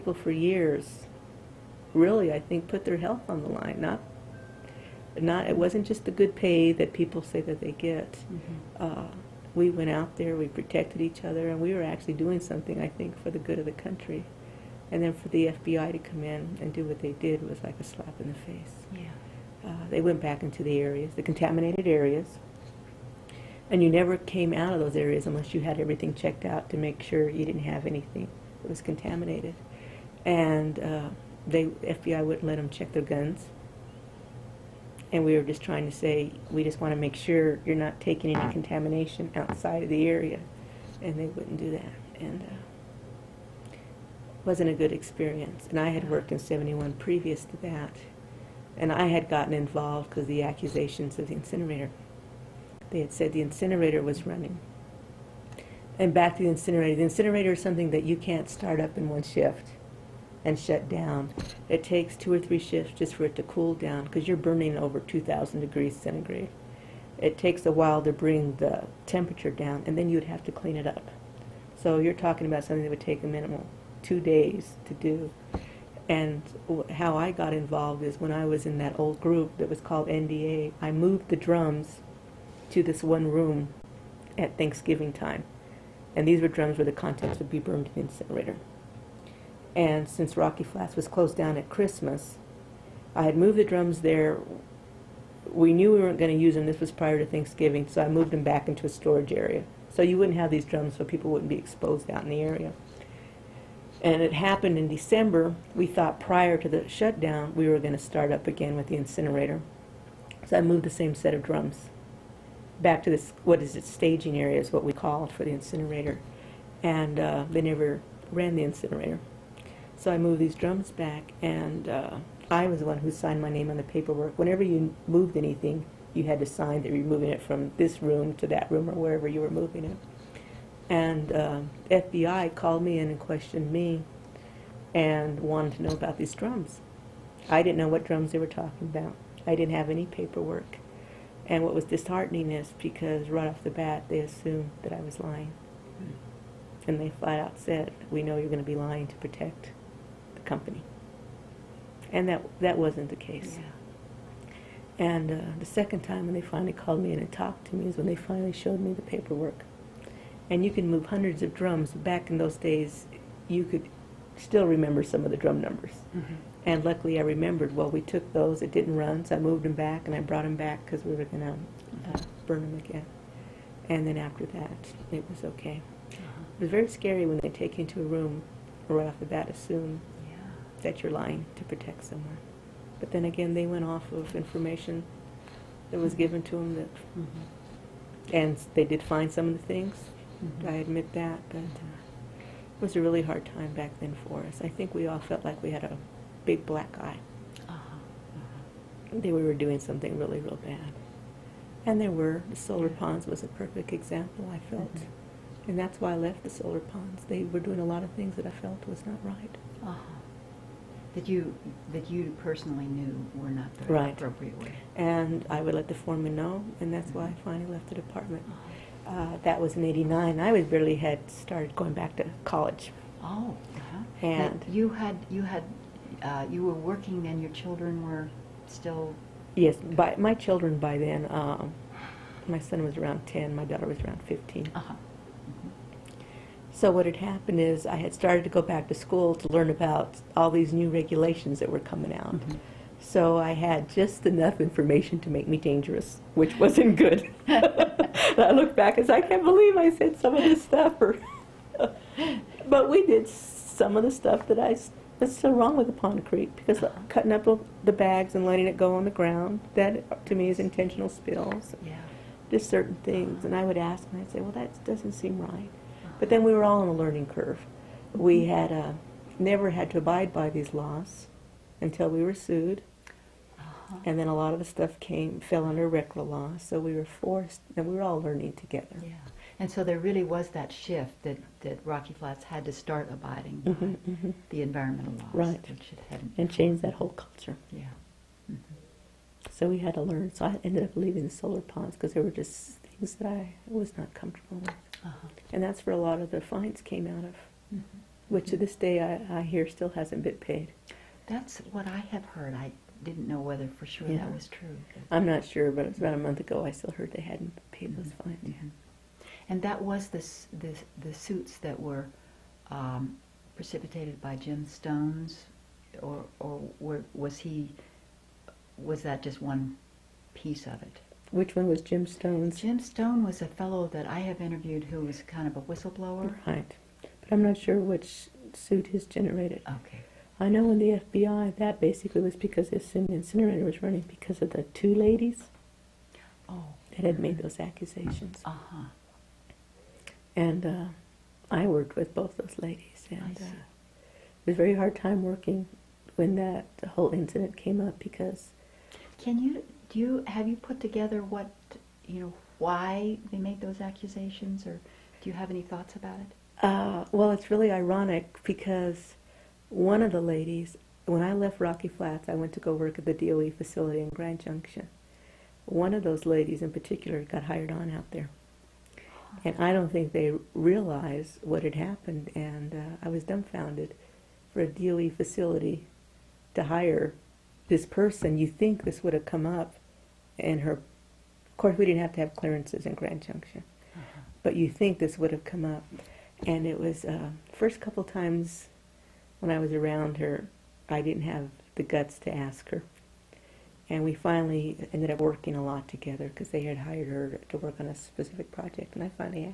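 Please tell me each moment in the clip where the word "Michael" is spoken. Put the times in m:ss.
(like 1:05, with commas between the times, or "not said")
not said.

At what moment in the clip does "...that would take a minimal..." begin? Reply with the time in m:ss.
1:12.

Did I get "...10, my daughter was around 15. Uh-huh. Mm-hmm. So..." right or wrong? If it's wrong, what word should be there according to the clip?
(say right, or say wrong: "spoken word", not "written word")
right.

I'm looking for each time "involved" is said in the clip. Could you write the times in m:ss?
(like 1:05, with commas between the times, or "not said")
0:49, 1:17.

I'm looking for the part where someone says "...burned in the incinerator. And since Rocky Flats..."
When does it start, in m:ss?
1:27.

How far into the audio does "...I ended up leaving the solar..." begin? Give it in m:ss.
4:50.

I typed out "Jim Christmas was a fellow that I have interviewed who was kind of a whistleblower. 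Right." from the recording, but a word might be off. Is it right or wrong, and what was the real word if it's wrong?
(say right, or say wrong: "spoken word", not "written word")
wrong: "Stone", not "Christmas".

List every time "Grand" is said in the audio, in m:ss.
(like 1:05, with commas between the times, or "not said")
6:04, 6:22.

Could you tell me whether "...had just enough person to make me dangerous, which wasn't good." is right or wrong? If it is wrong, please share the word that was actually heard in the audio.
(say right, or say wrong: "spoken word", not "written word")
wrong: "information", not "person".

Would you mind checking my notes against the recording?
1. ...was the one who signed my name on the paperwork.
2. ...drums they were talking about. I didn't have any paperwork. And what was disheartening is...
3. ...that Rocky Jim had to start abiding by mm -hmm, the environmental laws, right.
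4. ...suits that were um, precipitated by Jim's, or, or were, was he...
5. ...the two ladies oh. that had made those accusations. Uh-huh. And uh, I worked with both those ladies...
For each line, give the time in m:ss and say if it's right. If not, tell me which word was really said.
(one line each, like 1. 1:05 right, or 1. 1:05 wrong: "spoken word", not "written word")
1. 2:02 right
2. 2:18 right
3. 4:41 wrong: "Flats", not "Jim"
4. 5:11 wrong: "Stone", not "Jim"
5. 5:34 right.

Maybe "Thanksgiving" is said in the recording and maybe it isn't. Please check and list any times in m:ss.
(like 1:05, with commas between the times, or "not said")
1:24, 1:37.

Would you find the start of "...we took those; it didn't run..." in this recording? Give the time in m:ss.
2:47.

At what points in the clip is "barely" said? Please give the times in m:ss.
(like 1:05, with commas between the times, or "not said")
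3:40.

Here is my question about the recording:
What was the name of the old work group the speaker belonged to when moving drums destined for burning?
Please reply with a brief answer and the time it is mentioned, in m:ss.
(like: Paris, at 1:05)
NDA, at 1:20.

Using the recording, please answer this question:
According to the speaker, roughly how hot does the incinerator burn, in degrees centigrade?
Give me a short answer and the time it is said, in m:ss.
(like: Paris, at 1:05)
over 2,000, at 1:04.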